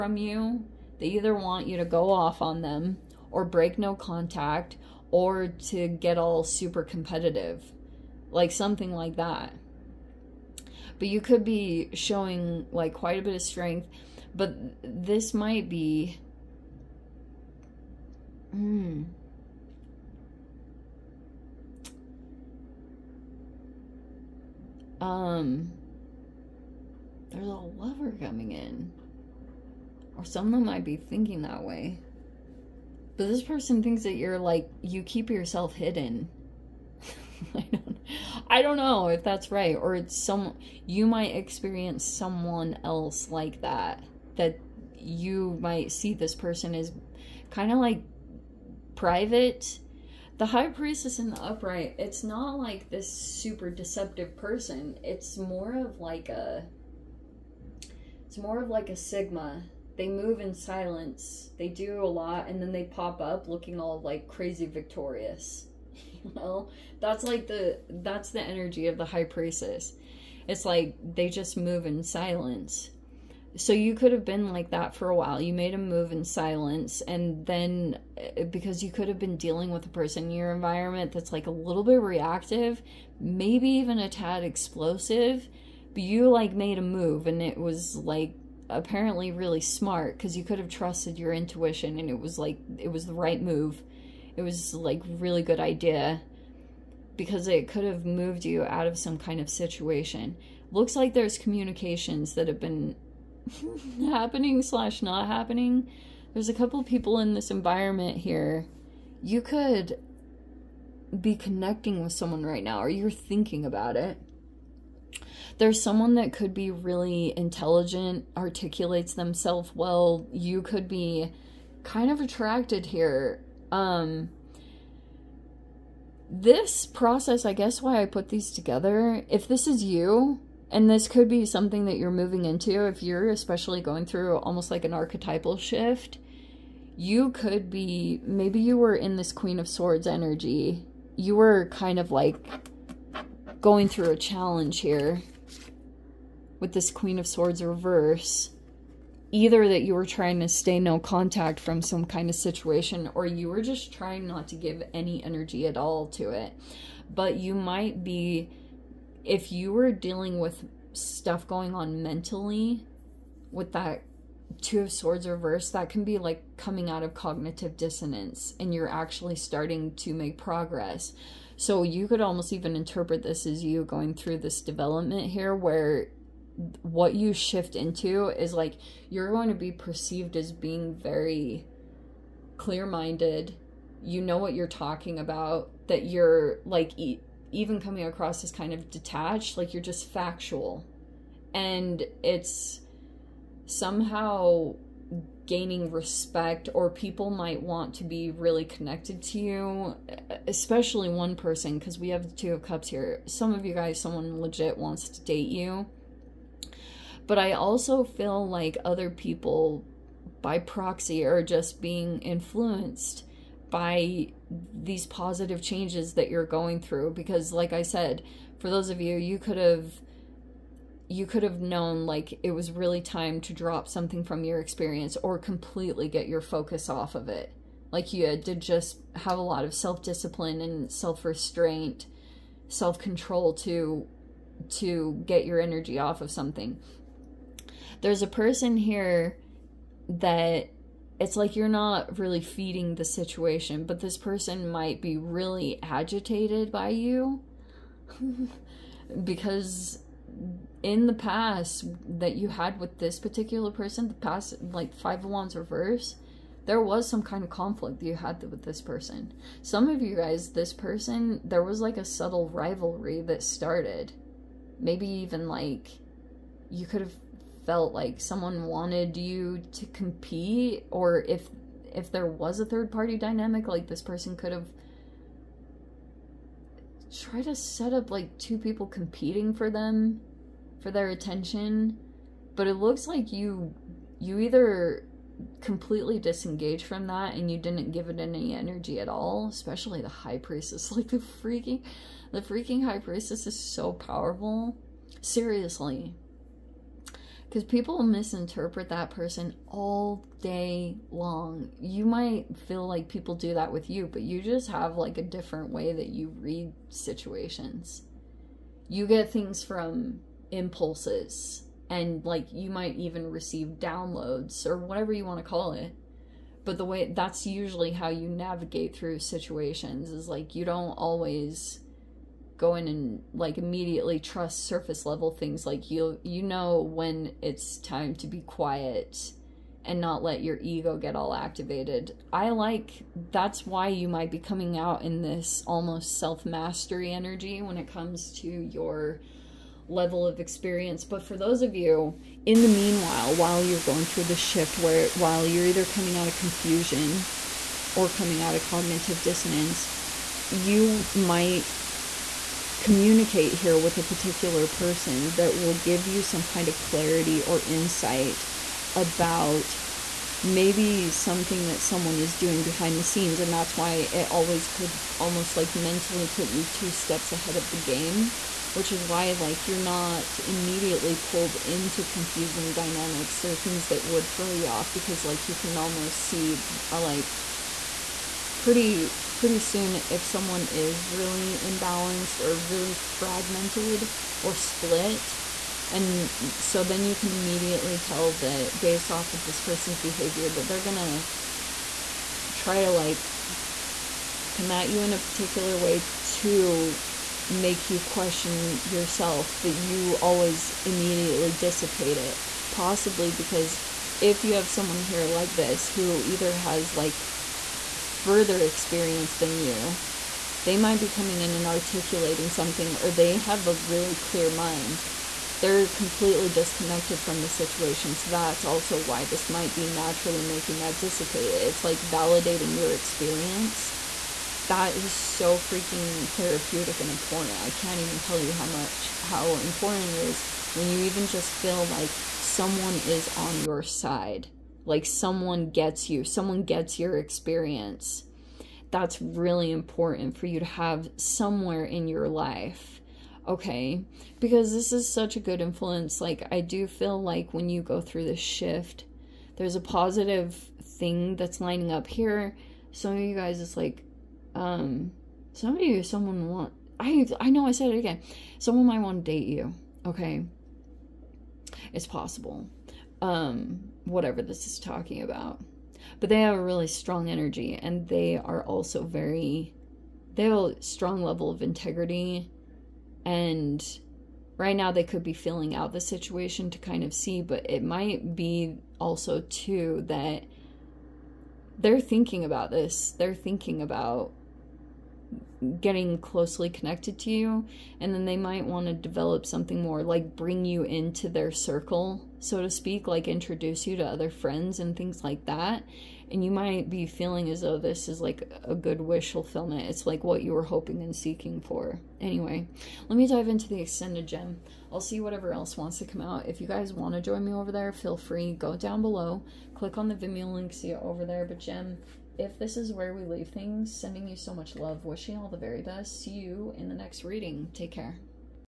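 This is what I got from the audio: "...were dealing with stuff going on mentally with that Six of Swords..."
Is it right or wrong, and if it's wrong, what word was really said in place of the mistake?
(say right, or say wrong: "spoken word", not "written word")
wrong: "Two", not "Six".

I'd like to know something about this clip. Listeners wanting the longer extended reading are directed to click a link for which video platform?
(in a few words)
Vimeo.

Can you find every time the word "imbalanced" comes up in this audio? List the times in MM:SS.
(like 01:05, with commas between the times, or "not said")
06:21.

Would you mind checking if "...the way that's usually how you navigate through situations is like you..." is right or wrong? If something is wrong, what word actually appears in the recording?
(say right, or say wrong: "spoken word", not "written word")
right.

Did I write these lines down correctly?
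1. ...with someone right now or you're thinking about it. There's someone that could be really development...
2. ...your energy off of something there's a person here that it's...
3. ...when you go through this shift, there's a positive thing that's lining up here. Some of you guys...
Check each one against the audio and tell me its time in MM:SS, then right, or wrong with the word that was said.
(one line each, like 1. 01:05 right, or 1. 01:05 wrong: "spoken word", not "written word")
1. 01:52 wrong: "intelligent", not "development"
2. 03:55 right
3. 07:27 right.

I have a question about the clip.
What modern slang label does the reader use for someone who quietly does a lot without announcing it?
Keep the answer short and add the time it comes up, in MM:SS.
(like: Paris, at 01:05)
sigma, at 00:58.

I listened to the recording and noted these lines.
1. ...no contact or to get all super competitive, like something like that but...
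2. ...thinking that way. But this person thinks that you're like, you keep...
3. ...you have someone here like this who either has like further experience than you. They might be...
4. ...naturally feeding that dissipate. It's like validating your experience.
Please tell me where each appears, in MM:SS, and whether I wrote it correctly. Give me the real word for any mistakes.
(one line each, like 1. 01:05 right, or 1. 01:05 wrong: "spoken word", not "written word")
1. 00:03 right
2. 00:30 right
3. 06:44 right
4. 06:59 wrong: "making", not "feeding".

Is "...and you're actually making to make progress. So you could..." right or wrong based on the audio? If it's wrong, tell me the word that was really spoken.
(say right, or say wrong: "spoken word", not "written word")
wrong: "starting", not "making".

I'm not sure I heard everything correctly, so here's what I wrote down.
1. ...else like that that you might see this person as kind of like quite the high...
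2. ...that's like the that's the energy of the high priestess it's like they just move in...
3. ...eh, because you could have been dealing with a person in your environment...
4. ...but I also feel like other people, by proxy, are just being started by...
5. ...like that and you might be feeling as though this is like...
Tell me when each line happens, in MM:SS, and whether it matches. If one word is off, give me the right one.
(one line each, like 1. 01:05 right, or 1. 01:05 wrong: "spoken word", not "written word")
1. 00:42 wrong: "private", not "quite"
2. 01:07 right
3. 01:18 right
4. 03:27 wrong: "influenced", not "started"
5. 08:15 right.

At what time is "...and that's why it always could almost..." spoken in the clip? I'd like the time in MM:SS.
06:03.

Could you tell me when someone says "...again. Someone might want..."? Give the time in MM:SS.
07:37.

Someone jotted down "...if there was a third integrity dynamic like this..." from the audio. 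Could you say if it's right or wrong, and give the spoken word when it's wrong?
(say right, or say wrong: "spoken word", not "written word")
wrong: "party", not "integrity".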